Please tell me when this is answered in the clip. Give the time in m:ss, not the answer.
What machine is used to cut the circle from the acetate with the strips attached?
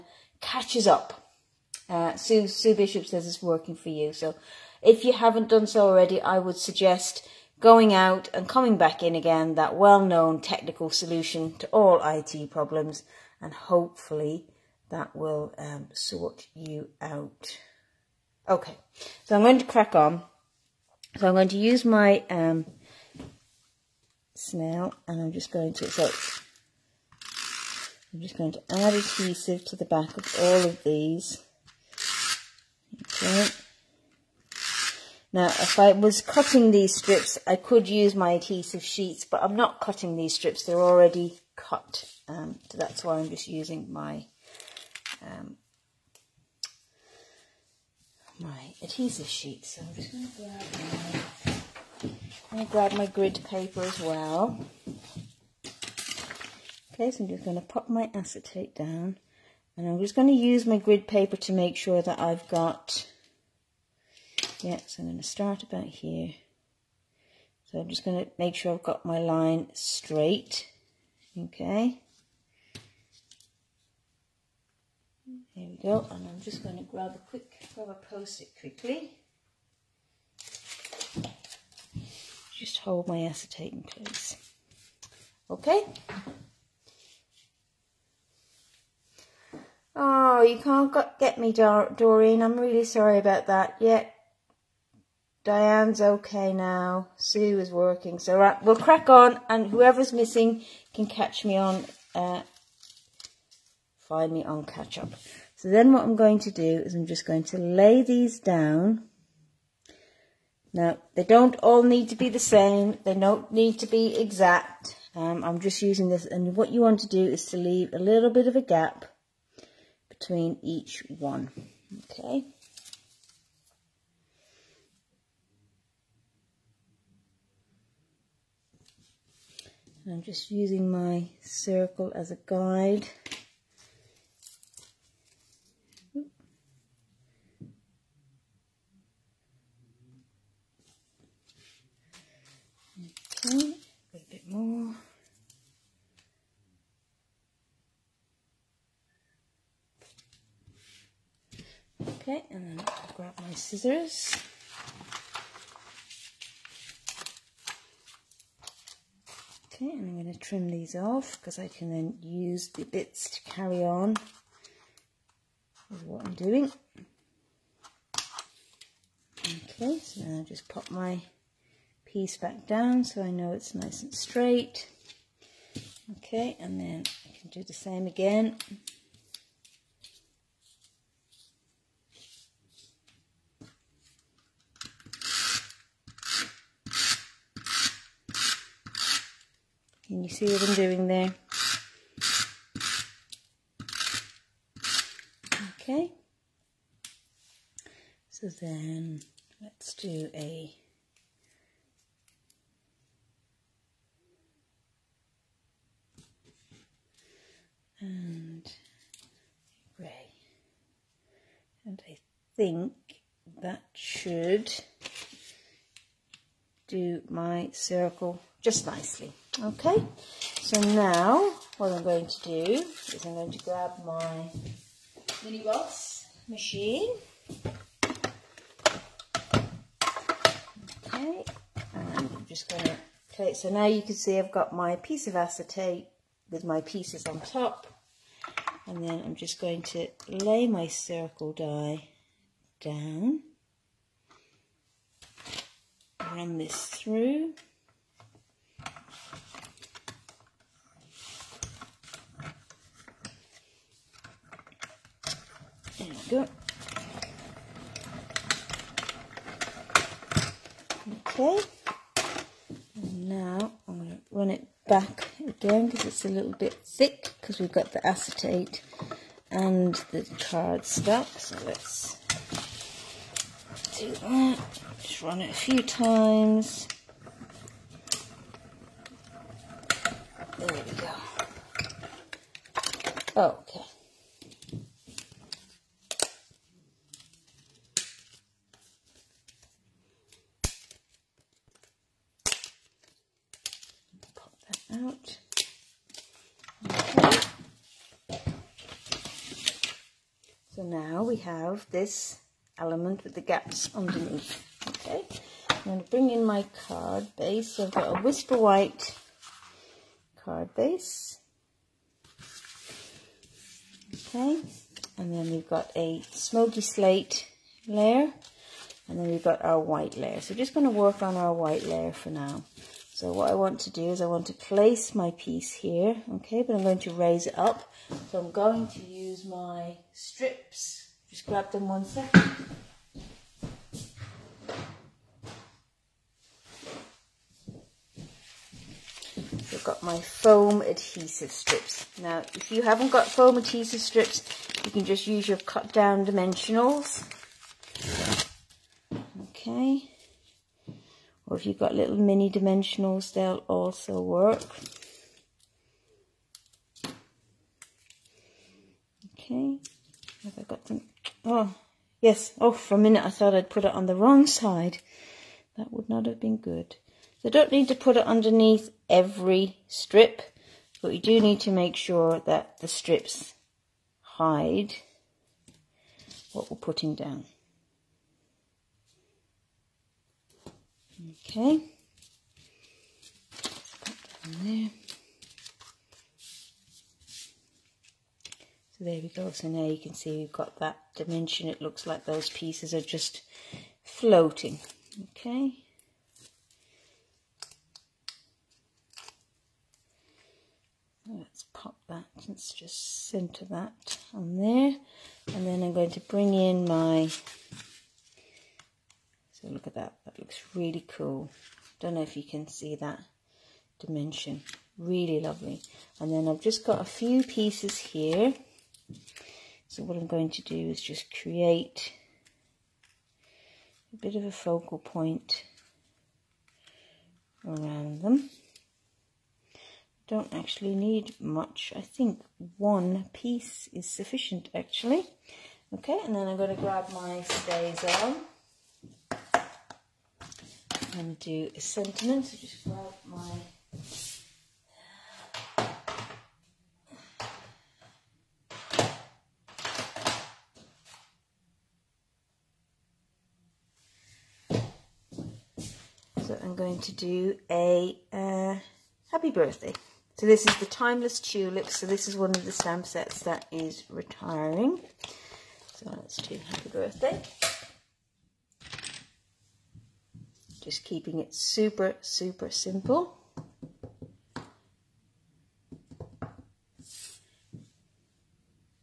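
3:45.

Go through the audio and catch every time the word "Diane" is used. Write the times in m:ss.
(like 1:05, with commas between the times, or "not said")
1:35.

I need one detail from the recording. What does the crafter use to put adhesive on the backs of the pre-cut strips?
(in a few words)
snail.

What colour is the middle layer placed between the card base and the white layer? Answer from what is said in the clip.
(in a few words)
smoky slate.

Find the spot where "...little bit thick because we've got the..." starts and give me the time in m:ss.
4:26.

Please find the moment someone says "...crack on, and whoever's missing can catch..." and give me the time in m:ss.
1:38.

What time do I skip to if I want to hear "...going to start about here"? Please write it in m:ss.
1:05.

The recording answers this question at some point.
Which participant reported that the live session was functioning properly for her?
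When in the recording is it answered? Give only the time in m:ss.
0:02.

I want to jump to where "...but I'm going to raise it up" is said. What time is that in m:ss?
5:26.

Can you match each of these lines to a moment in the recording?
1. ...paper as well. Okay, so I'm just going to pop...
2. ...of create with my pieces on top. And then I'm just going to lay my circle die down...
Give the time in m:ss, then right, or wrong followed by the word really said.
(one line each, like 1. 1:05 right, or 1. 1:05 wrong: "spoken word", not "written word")
1. 0:53 right
2. 3:55 wrong: "acetate", not "create".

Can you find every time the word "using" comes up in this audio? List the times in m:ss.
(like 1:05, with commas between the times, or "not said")
0:43, 1:55, 2:10.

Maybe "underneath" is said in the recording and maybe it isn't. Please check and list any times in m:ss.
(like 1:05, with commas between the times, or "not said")
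5:03, 6:08.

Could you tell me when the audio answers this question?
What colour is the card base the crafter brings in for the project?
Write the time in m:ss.
5:08.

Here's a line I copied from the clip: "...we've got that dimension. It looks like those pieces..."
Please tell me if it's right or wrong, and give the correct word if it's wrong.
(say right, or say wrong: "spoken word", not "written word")
right.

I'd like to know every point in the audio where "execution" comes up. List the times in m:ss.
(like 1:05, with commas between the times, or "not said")
not said.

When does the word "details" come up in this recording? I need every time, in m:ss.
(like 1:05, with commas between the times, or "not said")
not said.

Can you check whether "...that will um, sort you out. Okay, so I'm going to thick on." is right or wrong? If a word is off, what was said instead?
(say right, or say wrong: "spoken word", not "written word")
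wrong: "crack", not "thick".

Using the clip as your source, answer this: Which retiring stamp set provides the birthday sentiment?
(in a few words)
Timeless Tulips.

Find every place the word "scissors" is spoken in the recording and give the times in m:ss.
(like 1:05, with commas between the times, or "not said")
2:33.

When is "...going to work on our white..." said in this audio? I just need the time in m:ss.
5:20.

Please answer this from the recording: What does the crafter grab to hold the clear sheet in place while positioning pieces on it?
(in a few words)
a post-it.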